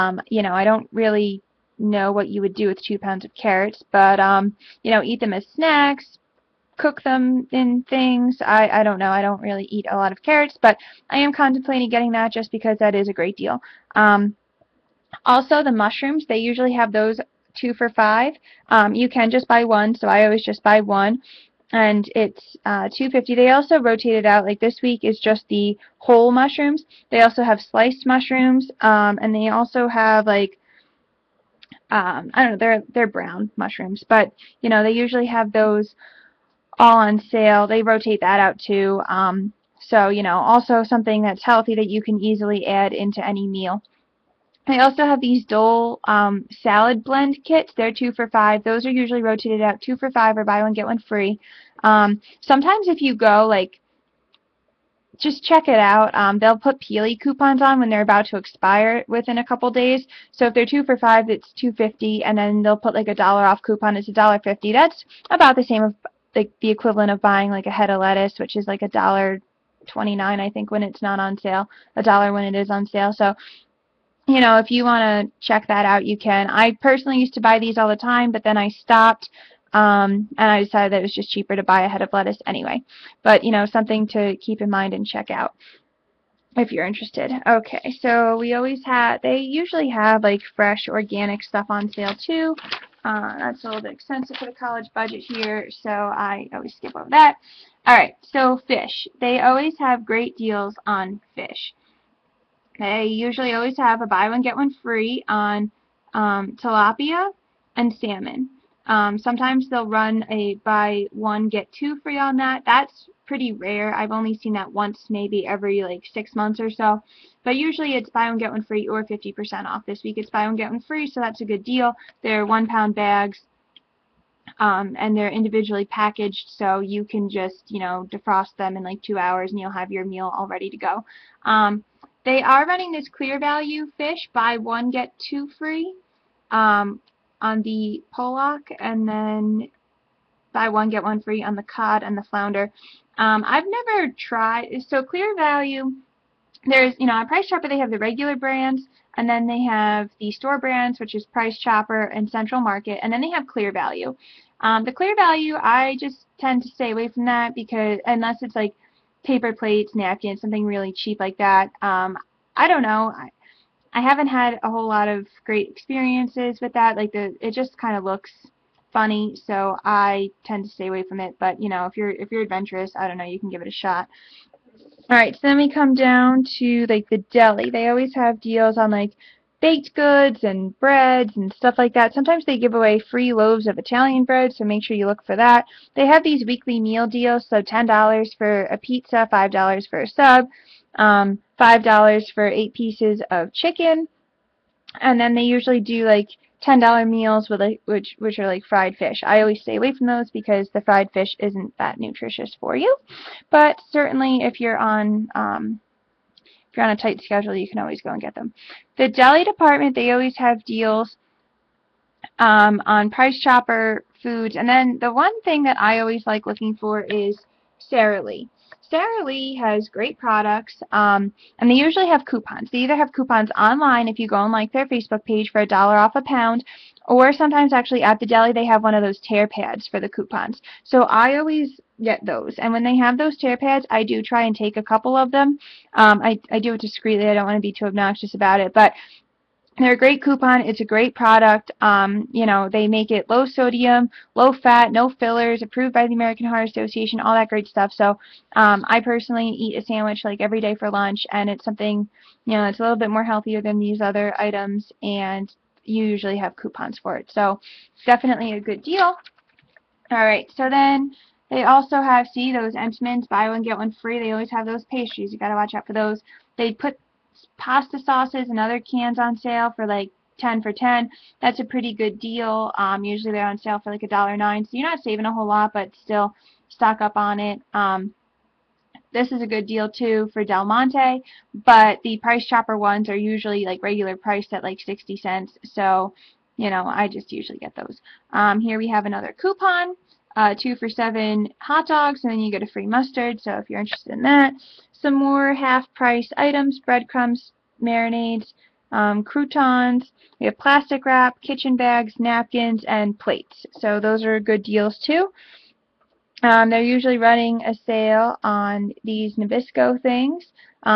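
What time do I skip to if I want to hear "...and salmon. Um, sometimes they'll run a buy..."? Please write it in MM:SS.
01:47.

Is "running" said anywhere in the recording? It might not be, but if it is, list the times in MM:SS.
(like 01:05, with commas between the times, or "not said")
02:12, 05:07.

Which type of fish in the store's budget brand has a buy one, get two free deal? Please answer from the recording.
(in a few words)
Pollock.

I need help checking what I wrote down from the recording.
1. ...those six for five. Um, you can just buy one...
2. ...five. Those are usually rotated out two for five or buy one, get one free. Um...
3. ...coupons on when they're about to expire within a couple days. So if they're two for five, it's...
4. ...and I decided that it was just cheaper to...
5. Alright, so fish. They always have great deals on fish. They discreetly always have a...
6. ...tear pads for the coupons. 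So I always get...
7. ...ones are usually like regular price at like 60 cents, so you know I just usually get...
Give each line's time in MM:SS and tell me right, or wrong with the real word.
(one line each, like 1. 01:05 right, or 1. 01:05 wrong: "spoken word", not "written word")
1. 00:16 wrong: "two", not "six"
2. 00:48 right
3. 00:57 right
4. 01:20 right
5. 01:37 wrong: "usually", not "discreetly"
6. 03:49 right
7. 04:42 right.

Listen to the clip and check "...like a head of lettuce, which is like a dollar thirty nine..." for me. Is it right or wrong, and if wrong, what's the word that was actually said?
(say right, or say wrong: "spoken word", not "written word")
wrong: "twenty", not "thirty".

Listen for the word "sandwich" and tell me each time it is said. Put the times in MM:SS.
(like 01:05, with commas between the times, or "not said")
04:09.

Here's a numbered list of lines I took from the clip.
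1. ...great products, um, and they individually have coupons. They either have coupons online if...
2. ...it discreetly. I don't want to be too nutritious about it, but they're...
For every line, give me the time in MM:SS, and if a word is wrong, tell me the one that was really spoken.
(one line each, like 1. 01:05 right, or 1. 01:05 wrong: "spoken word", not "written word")
1. 03:39 wrong: "usually", not "individually"
2. 03:56 wrong: "obnoxious", not "nutritious".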